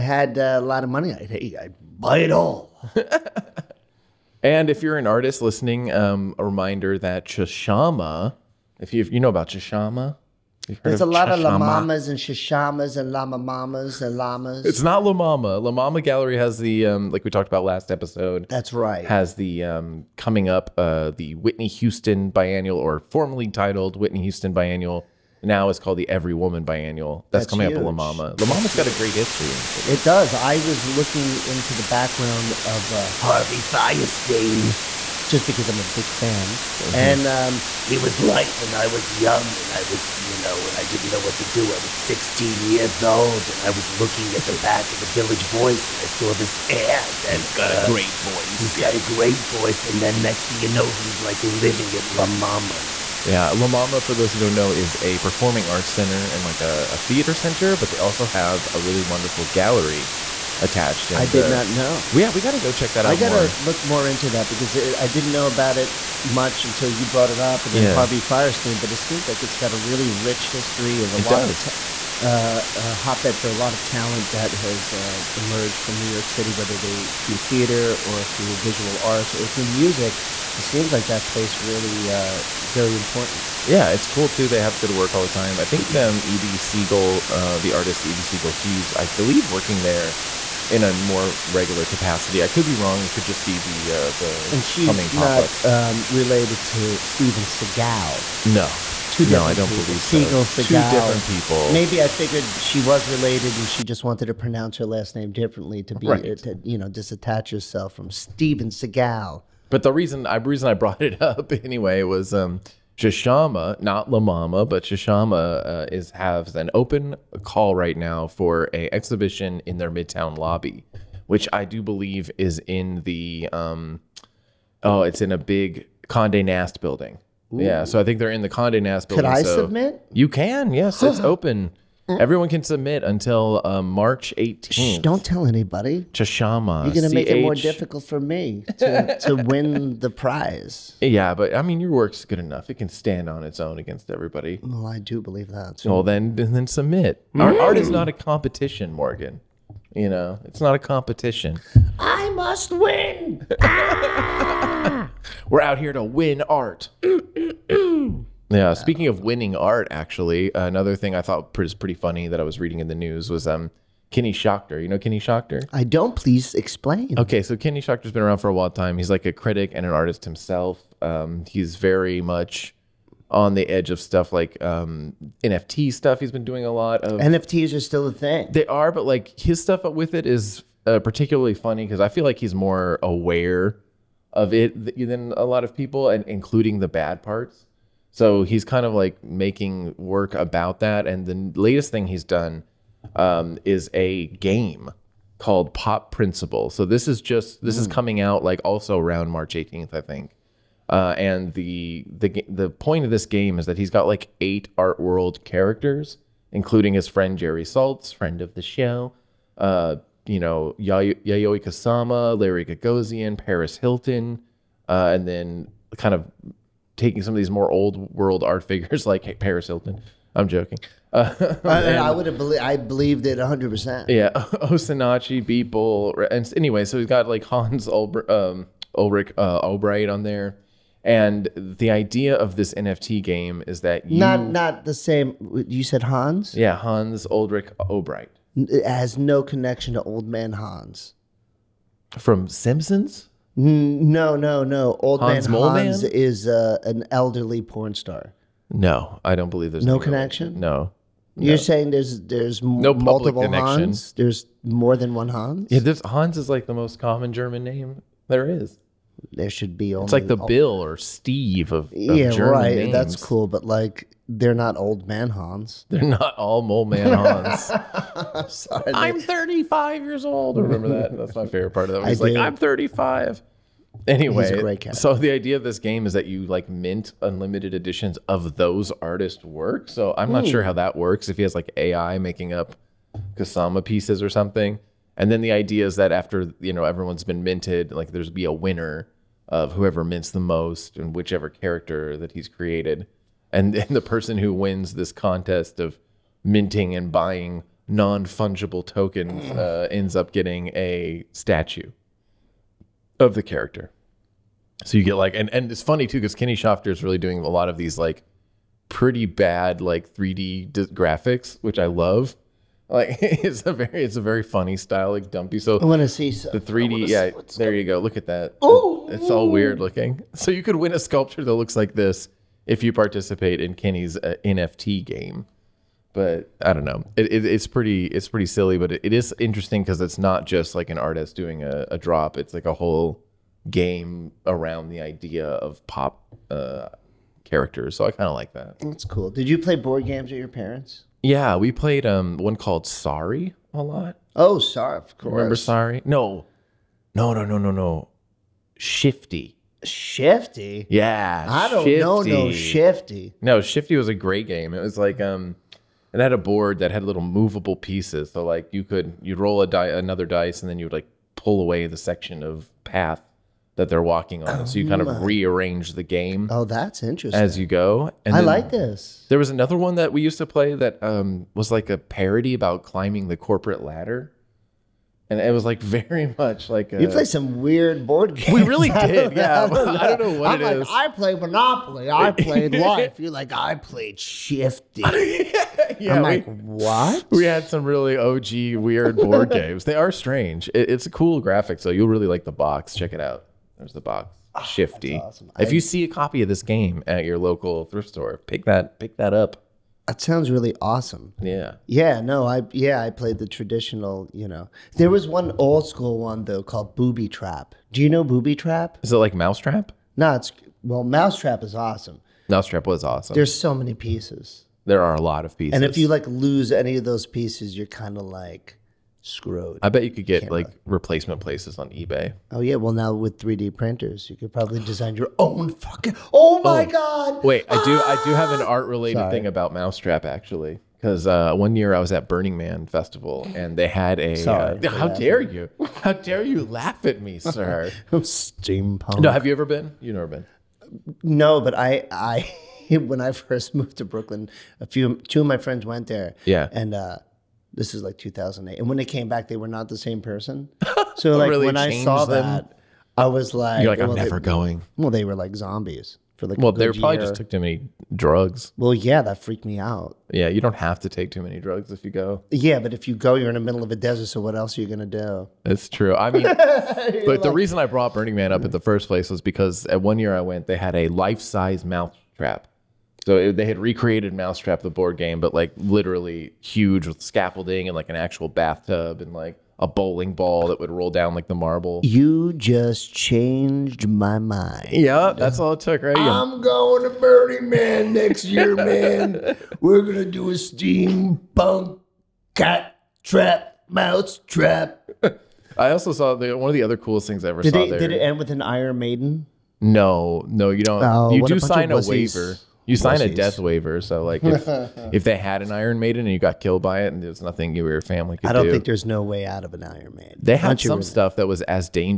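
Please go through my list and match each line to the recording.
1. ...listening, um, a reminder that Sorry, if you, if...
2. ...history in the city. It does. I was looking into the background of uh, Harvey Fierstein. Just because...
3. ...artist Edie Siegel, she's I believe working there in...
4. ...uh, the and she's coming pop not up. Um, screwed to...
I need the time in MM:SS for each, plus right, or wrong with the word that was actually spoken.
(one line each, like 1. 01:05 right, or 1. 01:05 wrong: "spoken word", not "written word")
1. 00:05 wrong: "Chashama", not "Sorry"
2. 00:29 right
3. 01:27 right
4. 01:33 wrong: "related", not "screwed".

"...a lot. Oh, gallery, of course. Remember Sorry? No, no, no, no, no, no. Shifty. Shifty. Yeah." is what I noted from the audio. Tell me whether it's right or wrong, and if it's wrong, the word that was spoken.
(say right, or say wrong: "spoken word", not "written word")
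wrong: "sorry", not "gallery".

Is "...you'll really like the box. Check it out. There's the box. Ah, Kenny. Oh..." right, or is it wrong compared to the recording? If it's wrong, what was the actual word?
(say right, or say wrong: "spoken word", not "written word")
wrong: "Shifty", not "Kenny".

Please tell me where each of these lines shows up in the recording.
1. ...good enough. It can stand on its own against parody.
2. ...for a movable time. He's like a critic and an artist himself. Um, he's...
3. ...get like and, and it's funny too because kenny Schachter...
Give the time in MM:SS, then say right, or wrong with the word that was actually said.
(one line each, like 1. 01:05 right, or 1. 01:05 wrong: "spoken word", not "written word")
1. 02:22 wrong: "everybody", not "parody"
2. 02:48 wrong: "while", not "movable"
3. 05:05 right.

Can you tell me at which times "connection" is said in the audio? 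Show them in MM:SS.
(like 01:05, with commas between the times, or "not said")
03:59, 04:09.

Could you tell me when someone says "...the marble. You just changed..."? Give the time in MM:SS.
08:01.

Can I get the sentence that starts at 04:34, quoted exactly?
Anyway, so the idea of this game is that you like mint unlimited editions of those artist works.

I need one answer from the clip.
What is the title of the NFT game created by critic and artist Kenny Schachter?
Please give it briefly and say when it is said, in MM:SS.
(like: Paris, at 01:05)
Pop Principle, at 03:15.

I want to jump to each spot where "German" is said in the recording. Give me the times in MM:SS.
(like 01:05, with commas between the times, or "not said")
04:17, 04:22.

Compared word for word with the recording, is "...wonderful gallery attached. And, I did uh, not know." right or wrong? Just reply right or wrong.
right.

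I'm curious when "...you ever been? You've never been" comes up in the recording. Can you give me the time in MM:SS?
07:19.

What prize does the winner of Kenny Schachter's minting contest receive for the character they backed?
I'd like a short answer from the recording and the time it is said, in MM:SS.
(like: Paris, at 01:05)
A statue, at 05:01.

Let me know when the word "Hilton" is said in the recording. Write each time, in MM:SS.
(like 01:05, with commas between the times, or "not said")
03:33, 03:39.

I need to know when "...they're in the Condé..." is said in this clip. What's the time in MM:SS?
02:08.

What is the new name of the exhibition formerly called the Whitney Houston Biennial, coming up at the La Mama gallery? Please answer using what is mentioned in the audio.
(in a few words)
Every Woman Biannual.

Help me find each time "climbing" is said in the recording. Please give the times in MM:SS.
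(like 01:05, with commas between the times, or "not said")
06:12.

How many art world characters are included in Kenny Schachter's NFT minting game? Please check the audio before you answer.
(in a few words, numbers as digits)
8.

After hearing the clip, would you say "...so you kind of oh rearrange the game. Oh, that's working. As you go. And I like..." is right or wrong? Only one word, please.
wrong.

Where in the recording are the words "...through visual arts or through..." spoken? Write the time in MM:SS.
01:18.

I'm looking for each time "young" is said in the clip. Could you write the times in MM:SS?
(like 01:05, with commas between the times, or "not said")
00:39.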